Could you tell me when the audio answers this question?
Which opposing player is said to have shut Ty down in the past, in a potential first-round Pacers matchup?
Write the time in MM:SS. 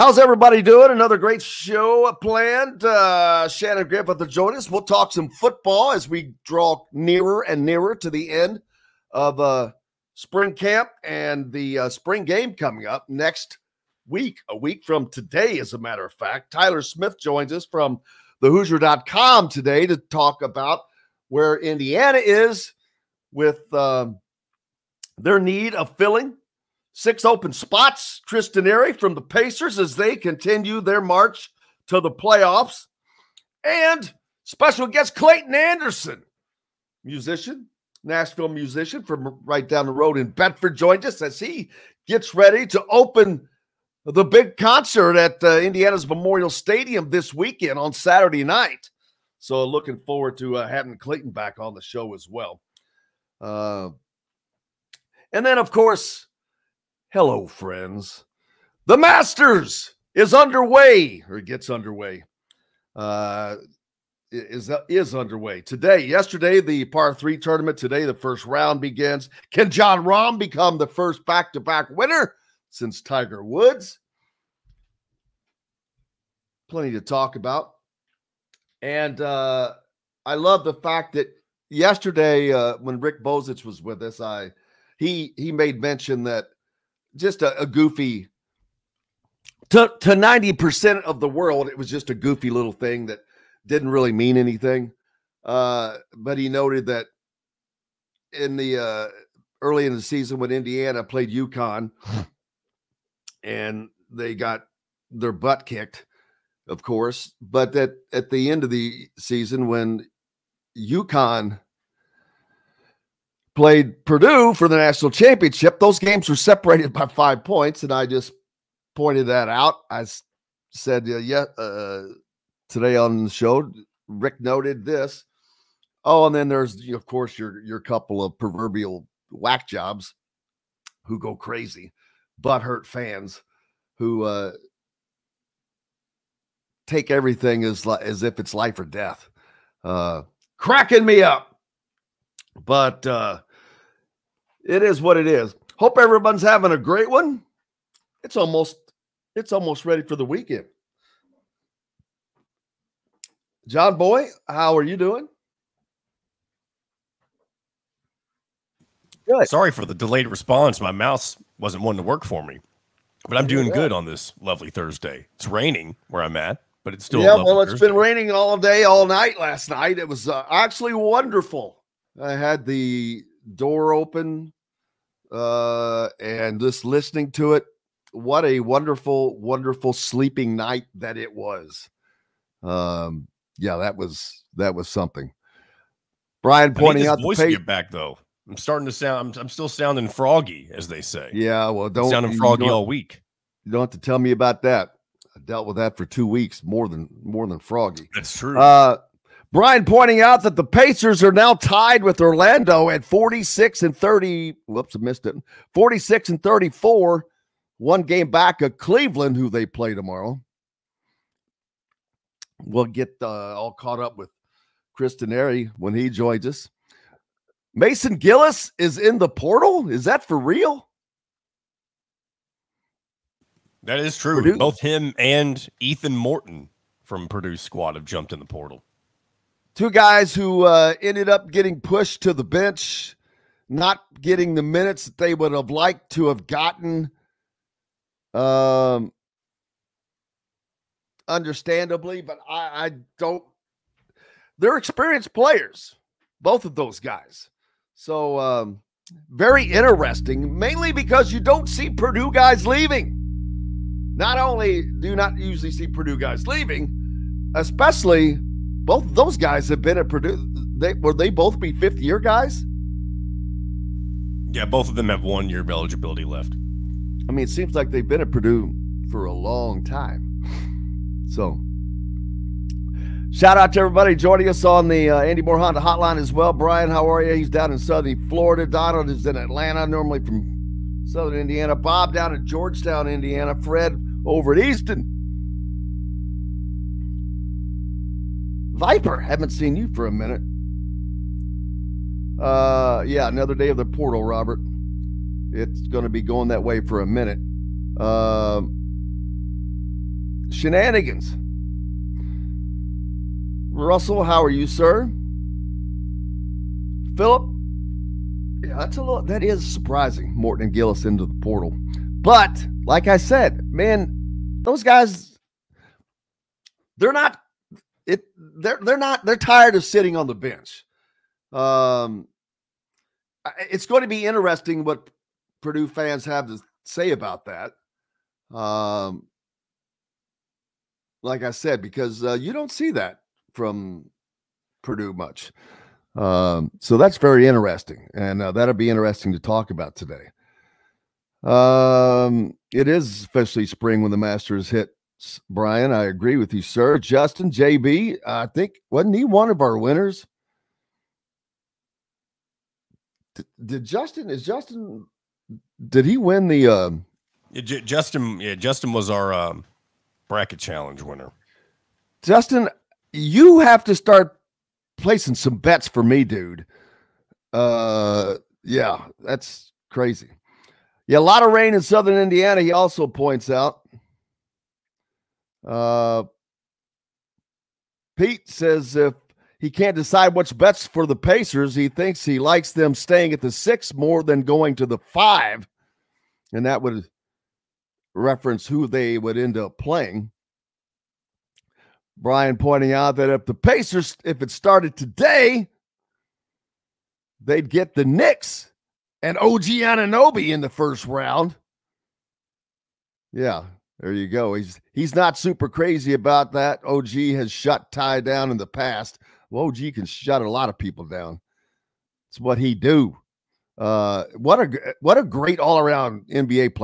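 06:39.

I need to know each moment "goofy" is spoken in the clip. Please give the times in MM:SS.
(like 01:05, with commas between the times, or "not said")
01:27, 01:32.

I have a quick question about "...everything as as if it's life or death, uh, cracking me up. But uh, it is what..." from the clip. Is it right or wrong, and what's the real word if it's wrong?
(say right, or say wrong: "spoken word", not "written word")
right.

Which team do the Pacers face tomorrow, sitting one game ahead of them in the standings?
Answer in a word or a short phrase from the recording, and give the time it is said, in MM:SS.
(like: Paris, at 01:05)
Cleveland, at 03:28.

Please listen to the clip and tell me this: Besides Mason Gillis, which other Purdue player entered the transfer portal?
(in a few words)
Ethan Morton.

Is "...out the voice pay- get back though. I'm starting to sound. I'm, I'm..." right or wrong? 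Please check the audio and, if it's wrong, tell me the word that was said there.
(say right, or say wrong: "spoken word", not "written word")
right.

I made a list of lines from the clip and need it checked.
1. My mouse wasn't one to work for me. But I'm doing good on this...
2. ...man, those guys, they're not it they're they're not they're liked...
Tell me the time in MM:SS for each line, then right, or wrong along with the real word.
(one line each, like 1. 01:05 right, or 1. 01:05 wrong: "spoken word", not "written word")
1. 02:40 right
2. 05:13 wrong: "tired", not "liked".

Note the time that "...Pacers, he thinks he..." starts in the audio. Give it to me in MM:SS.
06:21.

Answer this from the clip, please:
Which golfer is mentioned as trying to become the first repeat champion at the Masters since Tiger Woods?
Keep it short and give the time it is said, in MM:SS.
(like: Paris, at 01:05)
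Jon Rahm, at 01:09.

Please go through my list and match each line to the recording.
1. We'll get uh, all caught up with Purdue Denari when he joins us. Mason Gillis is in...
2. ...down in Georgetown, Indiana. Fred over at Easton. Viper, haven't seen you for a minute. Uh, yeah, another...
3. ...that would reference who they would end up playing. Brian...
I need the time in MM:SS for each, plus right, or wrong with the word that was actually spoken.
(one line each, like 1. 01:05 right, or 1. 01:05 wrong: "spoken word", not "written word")
1. 03:32 wrong: "Chris", not "Purdue"
2. 04:42 right
3. 06:26 right.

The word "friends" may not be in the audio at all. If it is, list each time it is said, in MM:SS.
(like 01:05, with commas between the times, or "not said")
00:57.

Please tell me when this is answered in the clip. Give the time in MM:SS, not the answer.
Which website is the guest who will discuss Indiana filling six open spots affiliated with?
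00:18.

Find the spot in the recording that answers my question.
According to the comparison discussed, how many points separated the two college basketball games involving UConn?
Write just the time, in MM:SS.
01:57.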